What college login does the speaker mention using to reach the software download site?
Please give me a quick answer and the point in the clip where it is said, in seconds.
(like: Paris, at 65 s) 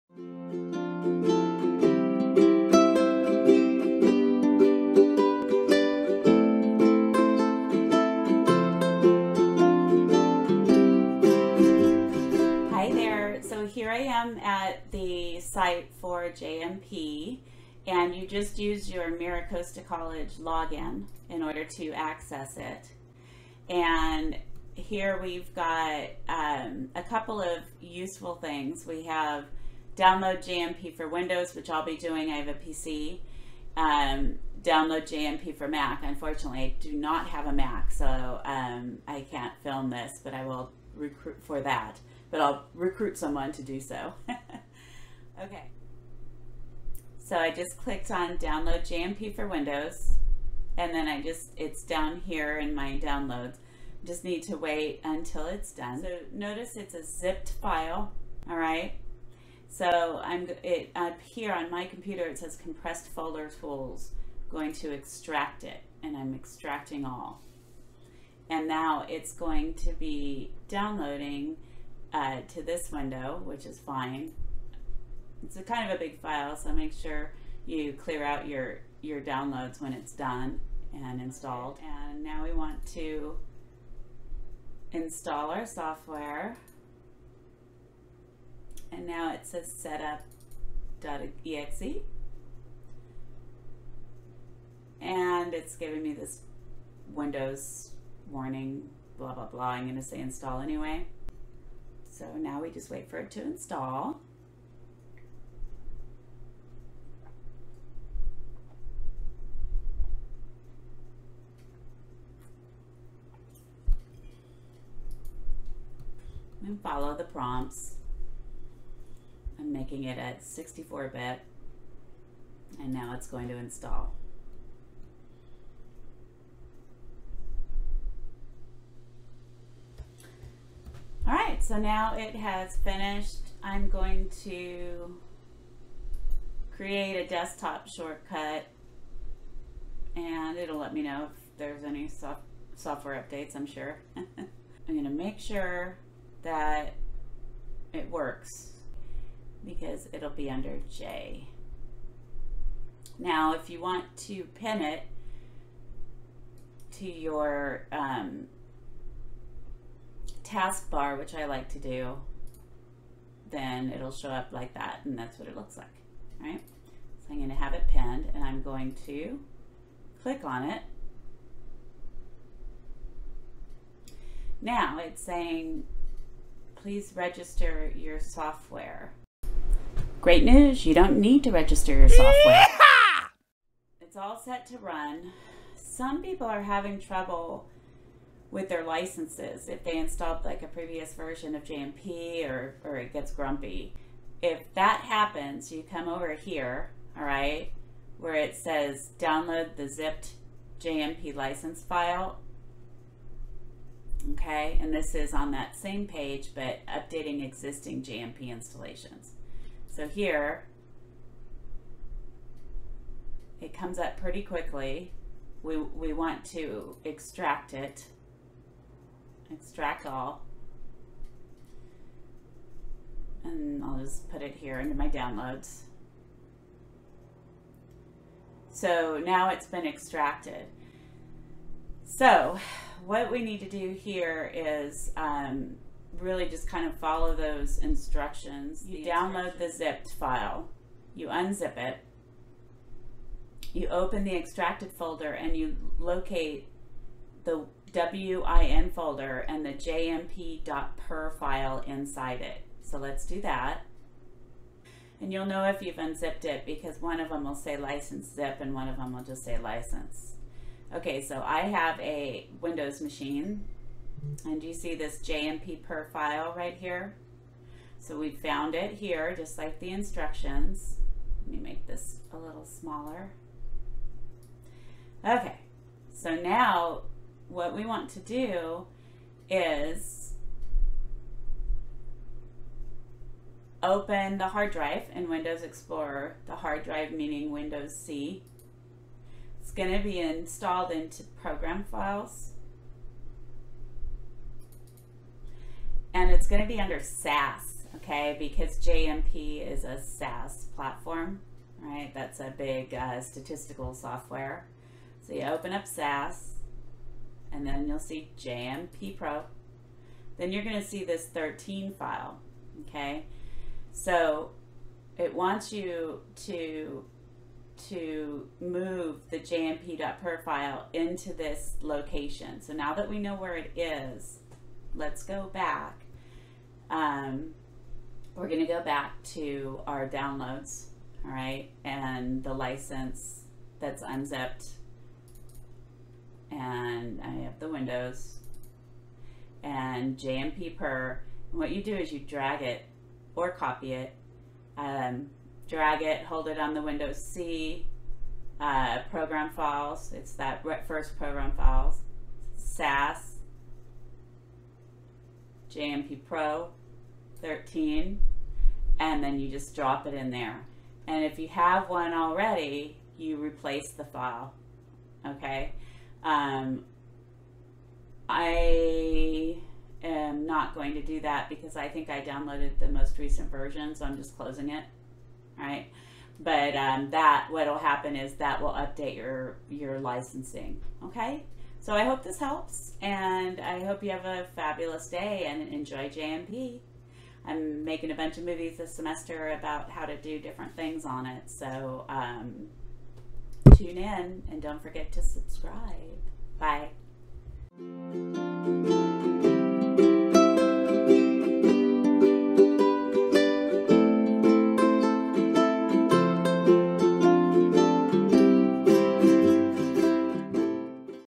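Miracosta College, at 19 s.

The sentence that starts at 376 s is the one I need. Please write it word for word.
But um, that, what'll happen is that will update your, your licensing, okay?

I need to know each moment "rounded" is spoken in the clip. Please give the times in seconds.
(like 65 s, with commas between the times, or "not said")
not said.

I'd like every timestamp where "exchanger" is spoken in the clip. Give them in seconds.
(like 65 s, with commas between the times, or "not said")
not said.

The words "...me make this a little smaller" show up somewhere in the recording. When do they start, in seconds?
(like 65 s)
271 s.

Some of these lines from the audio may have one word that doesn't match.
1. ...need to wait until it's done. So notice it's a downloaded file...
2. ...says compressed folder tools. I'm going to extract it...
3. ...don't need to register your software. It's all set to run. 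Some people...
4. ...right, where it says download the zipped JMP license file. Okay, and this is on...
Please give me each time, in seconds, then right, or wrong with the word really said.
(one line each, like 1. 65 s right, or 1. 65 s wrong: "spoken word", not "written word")
1. 54 s wrong: "zipped", not "downloaded"
2. 62 s right
3. 180 s right
4. 197 s right.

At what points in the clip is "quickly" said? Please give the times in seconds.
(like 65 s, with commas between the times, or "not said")
214 s.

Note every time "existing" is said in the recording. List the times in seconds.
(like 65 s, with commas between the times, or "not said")
207 s.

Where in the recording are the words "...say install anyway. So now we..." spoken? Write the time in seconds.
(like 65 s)
100 s.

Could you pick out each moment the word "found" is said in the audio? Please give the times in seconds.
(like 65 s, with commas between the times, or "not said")
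268 s.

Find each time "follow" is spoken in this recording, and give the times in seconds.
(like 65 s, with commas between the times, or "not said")
116 s, 236 s.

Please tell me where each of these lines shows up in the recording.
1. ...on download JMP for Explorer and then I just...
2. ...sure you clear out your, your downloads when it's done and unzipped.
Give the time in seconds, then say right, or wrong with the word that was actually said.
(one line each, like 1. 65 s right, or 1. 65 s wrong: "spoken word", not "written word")
1. 48 s wrong: "Windows", not "Explorer"
2. 76 s wrong: "installed", not "unzipped".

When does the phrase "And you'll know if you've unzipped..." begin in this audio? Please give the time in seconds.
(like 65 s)
255 s.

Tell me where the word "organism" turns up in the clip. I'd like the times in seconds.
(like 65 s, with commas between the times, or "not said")
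not said.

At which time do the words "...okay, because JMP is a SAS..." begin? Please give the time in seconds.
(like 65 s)
297 s.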